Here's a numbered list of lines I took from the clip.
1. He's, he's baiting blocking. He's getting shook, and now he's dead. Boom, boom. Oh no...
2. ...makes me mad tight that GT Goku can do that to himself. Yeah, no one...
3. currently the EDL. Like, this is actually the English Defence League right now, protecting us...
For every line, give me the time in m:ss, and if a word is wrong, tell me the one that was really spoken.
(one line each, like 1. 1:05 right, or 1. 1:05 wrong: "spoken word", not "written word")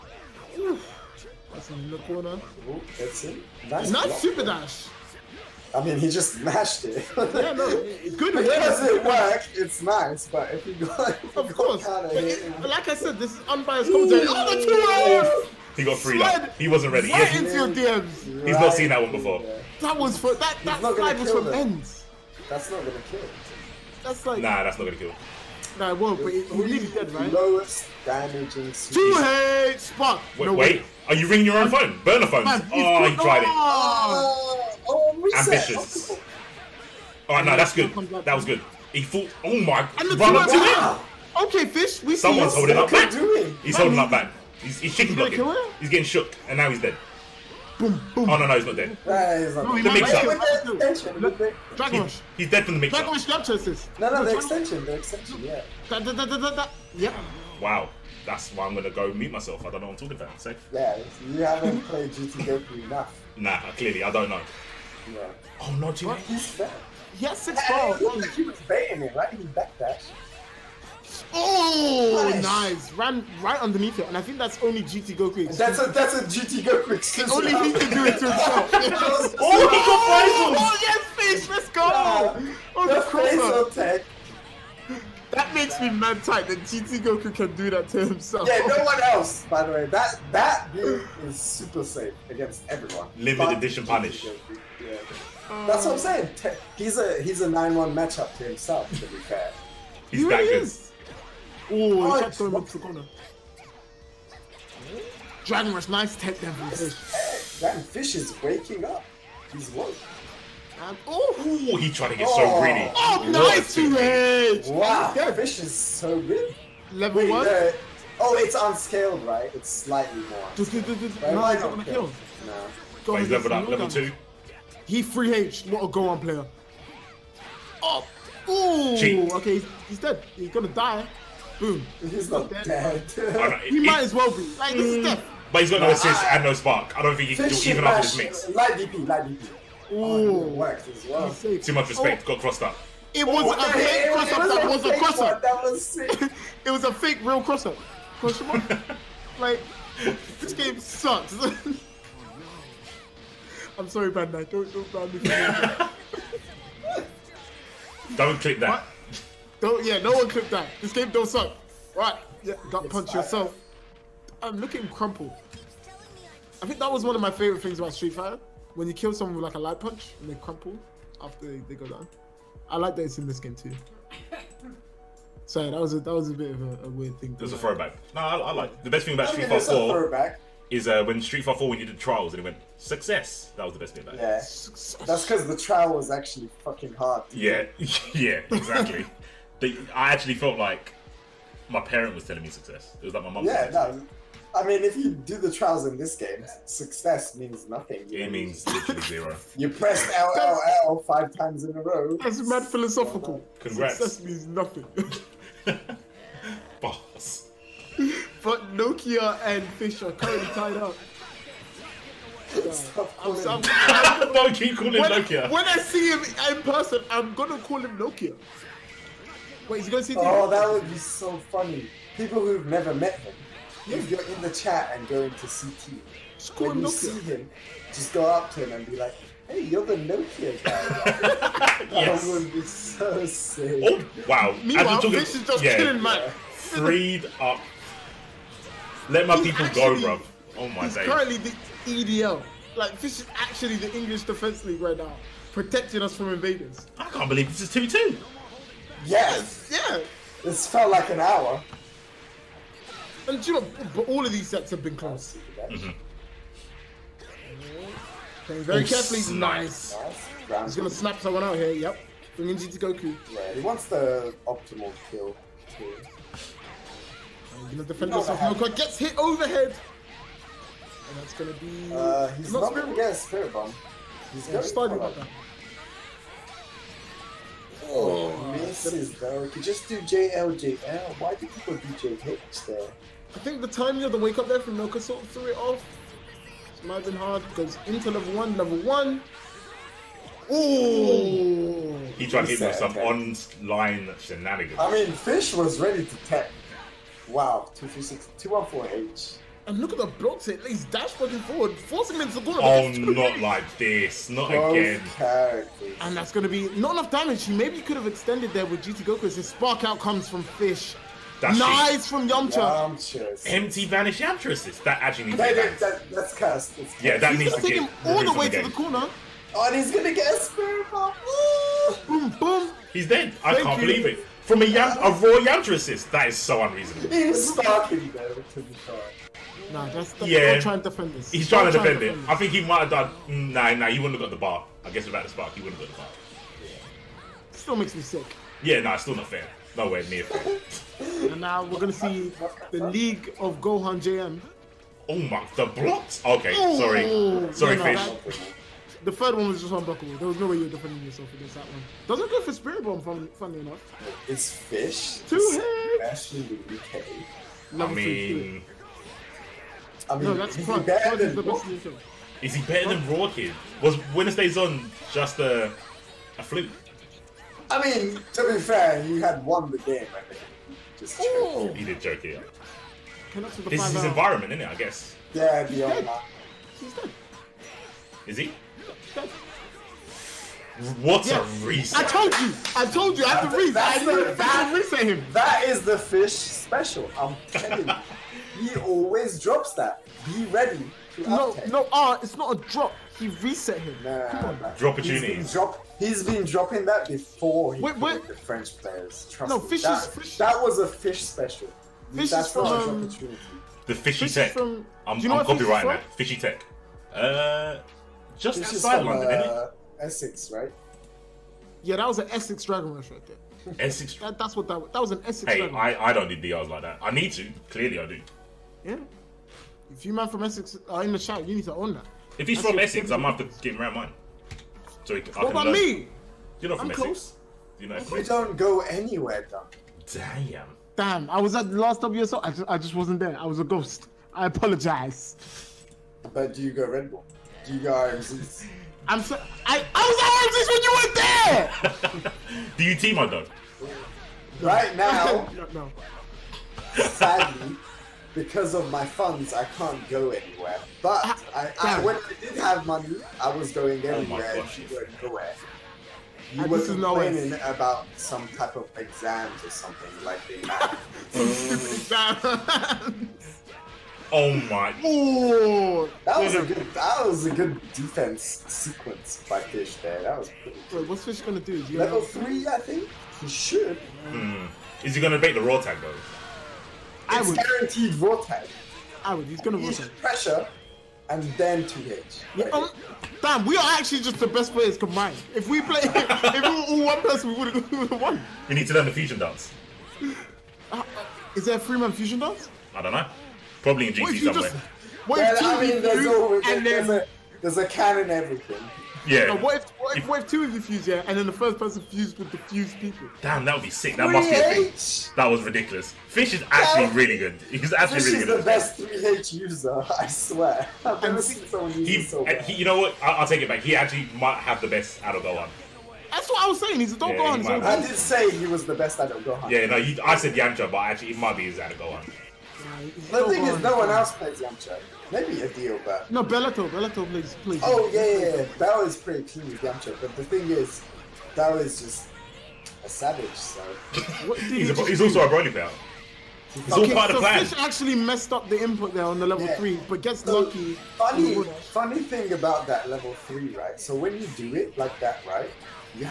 1. 0:44 wrong: "shaking", not "baiting"
2. 1:25 right
3. 4:01 right.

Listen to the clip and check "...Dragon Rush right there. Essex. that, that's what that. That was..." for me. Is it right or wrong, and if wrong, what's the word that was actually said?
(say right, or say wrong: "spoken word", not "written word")
right.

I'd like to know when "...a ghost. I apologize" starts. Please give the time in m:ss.
7:13.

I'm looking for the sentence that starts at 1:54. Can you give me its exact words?
Wow, their vision is so good.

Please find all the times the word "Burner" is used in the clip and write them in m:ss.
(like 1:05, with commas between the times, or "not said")
0:32.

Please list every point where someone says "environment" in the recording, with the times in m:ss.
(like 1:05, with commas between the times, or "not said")
6:14.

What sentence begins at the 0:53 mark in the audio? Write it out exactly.
Dragon Rush snap No, no, the extension.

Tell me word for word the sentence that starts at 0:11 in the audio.
Go but it, him, like I said, this is unbiased commentary.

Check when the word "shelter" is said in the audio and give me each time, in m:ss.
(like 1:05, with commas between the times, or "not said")
not said.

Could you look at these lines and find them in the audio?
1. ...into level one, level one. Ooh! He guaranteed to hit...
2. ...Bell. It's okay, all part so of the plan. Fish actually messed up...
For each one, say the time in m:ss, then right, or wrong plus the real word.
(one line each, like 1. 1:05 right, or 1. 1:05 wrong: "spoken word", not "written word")
1. 4:47 wrong: "tried", not "guaranteed"
2. 8:55 right.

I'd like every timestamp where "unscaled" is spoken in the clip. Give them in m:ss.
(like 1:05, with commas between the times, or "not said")
1:58.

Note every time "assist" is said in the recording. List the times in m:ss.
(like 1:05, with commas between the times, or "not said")
2:15, 5:14, 5:25.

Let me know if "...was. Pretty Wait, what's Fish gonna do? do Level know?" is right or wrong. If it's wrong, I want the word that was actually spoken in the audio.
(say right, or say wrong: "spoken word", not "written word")
right.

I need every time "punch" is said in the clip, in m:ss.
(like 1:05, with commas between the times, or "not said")
2:42, 2:49.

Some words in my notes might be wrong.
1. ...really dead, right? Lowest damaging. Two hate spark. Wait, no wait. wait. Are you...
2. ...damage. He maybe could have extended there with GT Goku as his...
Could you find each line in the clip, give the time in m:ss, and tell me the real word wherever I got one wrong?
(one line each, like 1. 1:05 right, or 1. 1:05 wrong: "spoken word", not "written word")
1. 0:26 right
2. 5:07 right.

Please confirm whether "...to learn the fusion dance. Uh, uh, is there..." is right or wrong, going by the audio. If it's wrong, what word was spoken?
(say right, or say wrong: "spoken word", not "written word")
right.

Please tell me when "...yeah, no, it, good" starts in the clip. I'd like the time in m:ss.
0:07.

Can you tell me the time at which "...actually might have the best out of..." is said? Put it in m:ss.
8:33.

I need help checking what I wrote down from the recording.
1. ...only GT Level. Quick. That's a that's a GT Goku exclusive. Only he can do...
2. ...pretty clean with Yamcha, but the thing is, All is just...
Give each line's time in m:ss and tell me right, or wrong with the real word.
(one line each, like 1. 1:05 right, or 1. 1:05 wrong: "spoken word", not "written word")
1. 1:14 wrong: "Goku", not "Level"
2. 8:49 wrong: "Bell", not "All".